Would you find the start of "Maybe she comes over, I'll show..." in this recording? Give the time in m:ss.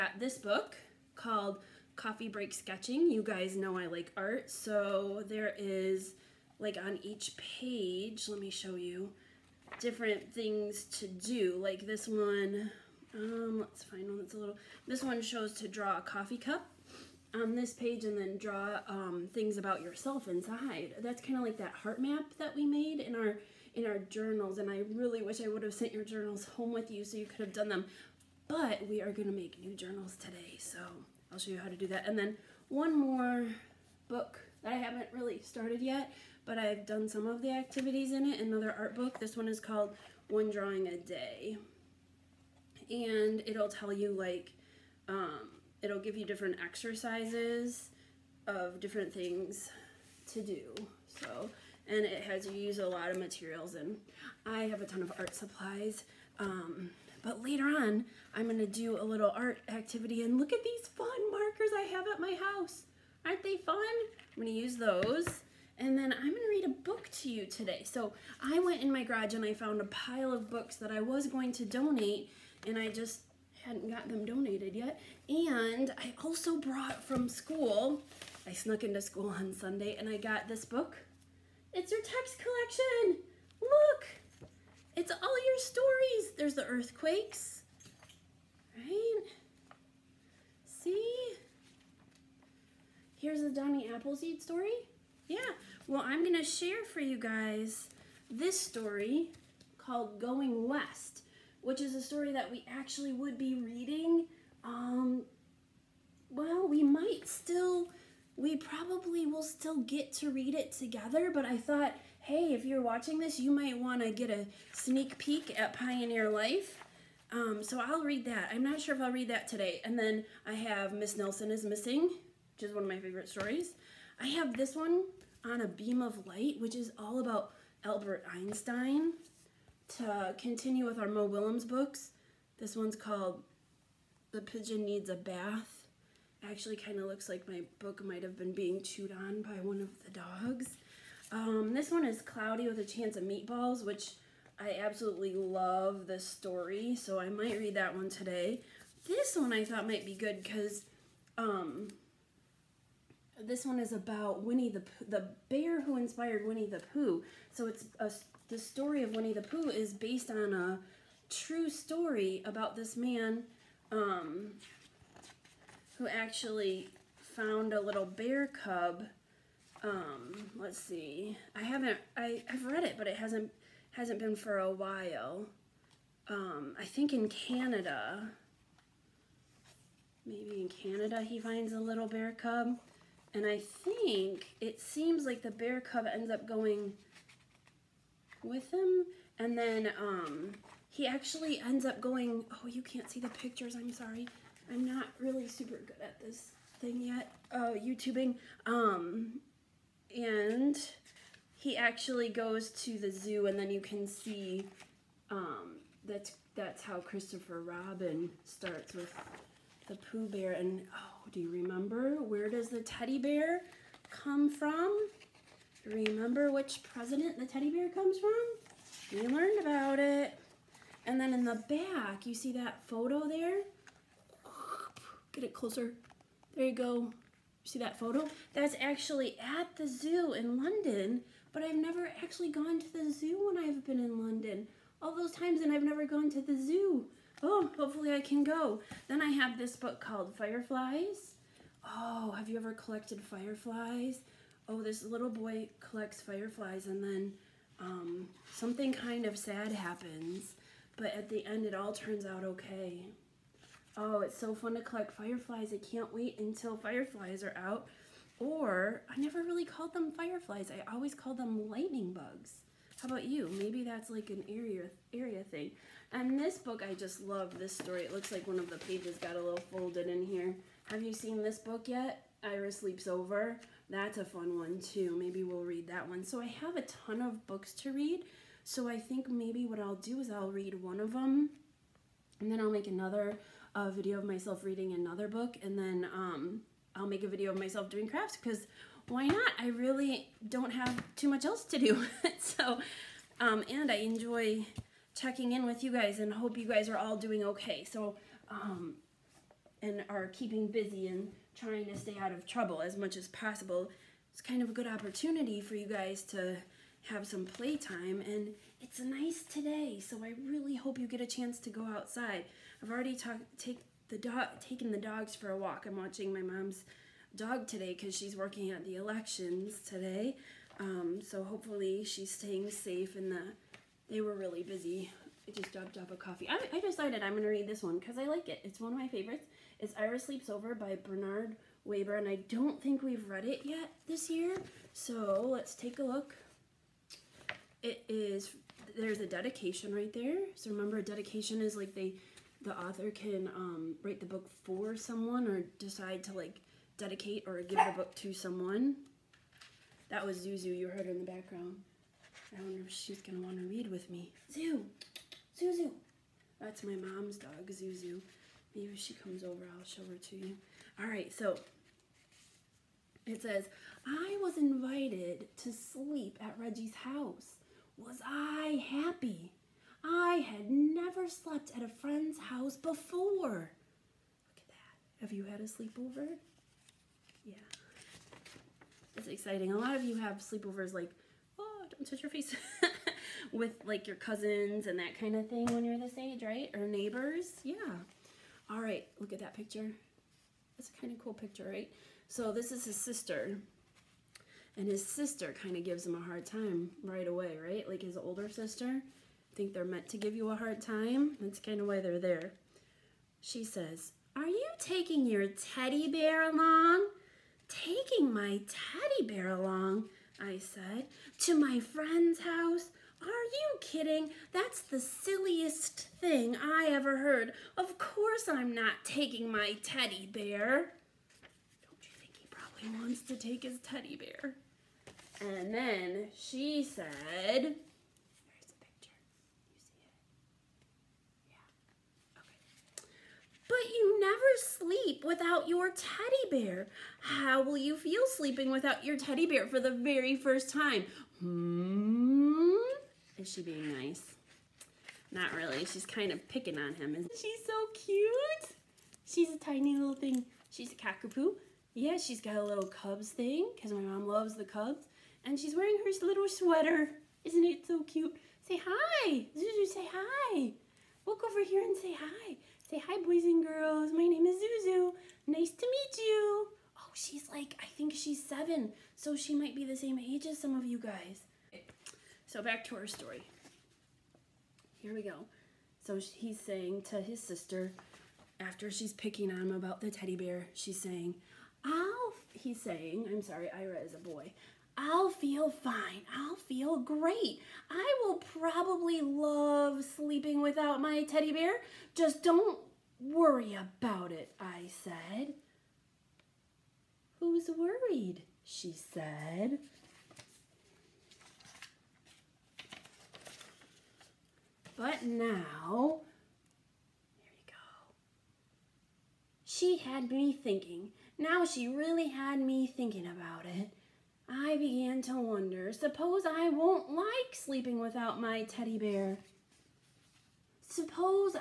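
5:58.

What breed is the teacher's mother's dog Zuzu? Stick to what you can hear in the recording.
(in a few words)
cockapoo.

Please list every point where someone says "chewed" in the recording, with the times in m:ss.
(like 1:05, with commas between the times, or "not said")
2:18.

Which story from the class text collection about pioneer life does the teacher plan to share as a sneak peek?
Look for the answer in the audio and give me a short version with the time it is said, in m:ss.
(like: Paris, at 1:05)
Going West, at 1:40.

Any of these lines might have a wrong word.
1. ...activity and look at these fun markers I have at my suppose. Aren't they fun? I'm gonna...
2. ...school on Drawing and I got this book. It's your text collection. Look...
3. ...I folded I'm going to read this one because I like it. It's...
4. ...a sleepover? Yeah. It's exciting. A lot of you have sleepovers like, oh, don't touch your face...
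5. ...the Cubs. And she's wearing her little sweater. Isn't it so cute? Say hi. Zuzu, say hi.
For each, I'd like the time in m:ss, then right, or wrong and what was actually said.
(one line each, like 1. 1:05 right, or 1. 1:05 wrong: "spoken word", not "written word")
1. 0:59 wrong: "house", not "suppose"
2. 1:19 wrong: "Sunday", not "Drawing"
3. 5:26 wrong: "decided", not "folded"
4. 6:15 right
5. 7:34 right.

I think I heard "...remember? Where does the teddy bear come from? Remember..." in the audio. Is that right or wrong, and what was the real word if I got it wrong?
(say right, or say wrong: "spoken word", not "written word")
right.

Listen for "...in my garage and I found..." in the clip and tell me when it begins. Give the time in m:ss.
1:08.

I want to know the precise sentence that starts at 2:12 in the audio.
This one's called The Pigeon Needs a Bath.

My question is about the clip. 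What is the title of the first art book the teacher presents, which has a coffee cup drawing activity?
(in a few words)
Coffee Break Sketching.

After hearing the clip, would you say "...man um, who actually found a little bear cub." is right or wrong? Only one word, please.
right.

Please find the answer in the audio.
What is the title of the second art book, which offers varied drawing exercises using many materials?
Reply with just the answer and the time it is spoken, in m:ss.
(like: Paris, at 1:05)
One Drawing a Day, at 0:40.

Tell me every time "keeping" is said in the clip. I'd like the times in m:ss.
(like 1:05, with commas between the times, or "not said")
5:00.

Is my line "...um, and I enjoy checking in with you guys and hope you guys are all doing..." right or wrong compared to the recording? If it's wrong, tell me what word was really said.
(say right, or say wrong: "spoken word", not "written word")
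right.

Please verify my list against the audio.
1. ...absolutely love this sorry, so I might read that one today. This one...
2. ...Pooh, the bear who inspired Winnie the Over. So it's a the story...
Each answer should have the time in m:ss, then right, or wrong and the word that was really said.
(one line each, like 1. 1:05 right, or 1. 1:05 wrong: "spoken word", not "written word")
1. 2:24 wrong: "story", not "sorry"
2. 2:34 wrong: "Pooh", not "Over".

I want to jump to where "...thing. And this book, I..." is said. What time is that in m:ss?
4:25.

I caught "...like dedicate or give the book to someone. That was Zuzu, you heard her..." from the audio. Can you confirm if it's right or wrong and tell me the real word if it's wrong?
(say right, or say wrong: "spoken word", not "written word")
right.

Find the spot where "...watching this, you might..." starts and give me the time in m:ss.
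1:52.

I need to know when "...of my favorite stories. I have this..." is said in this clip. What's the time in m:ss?
2:02.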